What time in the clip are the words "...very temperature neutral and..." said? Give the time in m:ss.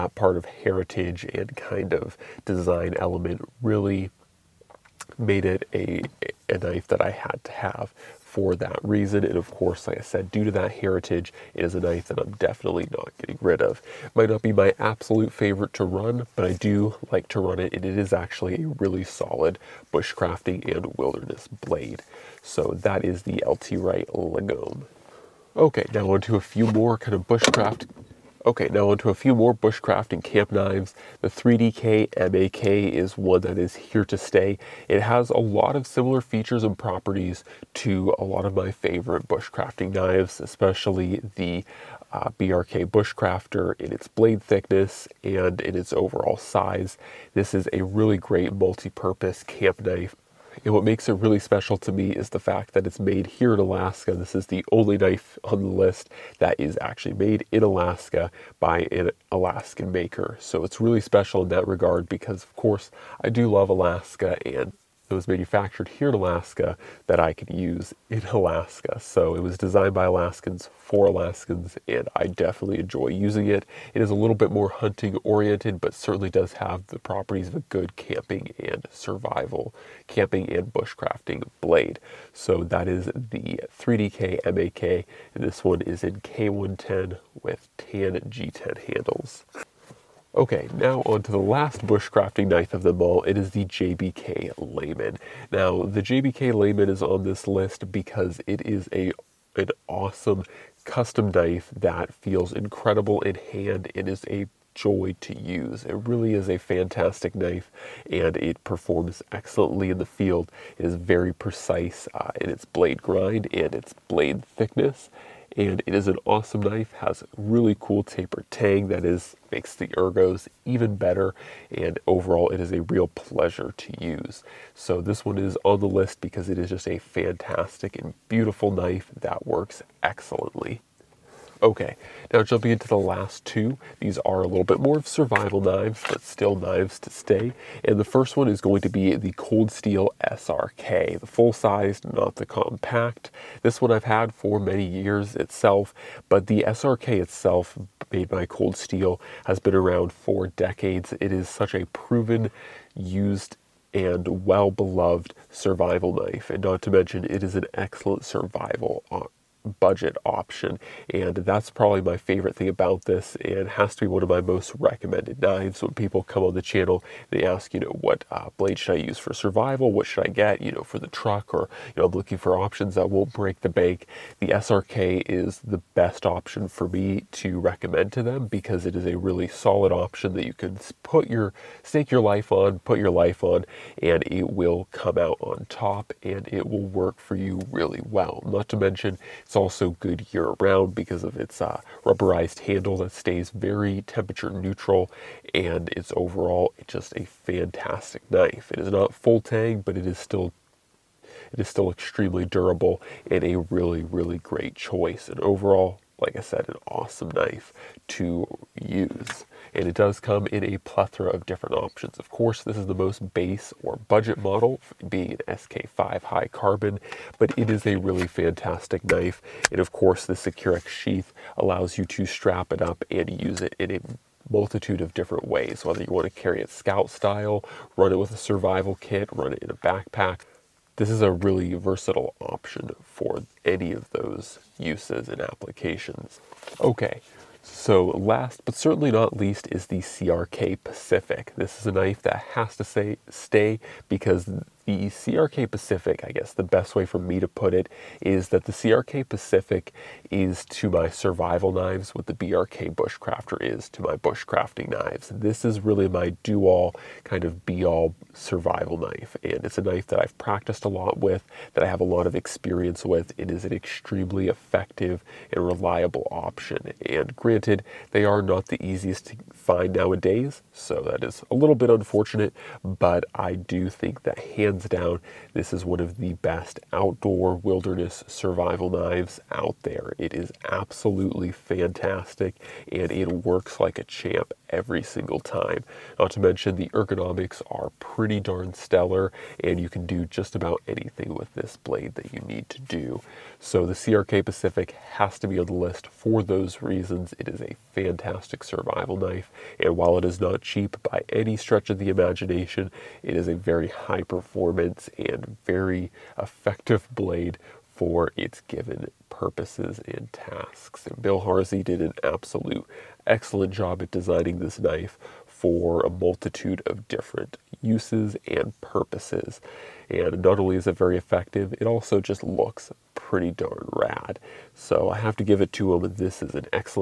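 3:13.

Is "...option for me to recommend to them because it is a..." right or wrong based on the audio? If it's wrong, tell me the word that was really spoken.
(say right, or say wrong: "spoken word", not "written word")
right.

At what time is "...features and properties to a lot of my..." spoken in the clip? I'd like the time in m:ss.
0:36.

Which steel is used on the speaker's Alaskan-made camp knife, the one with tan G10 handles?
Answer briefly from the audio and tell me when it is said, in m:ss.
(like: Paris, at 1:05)
K110, at 1:26.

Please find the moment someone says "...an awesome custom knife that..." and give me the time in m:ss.
1:39.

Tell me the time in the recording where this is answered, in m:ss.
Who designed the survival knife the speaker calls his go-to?
5:11.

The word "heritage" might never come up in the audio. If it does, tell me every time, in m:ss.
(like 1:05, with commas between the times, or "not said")
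0:00, 0:10.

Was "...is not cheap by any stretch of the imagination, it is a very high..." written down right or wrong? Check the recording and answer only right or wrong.
right.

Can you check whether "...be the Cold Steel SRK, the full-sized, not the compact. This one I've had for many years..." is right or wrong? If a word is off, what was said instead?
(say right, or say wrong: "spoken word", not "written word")
right.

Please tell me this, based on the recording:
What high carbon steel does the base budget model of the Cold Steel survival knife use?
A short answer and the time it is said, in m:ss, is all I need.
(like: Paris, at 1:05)
SK5, at 3:35.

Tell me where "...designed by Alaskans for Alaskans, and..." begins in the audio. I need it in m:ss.
1:09.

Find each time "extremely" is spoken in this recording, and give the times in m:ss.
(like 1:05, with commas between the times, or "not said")
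3:21, 4:23.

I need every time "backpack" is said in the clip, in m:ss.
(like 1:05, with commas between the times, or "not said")
3:49.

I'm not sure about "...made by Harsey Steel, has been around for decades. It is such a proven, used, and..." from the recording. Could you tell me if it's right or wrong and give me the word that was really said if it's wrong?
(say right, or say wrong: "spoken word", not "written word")
wrong: "Cold", not "Harsey".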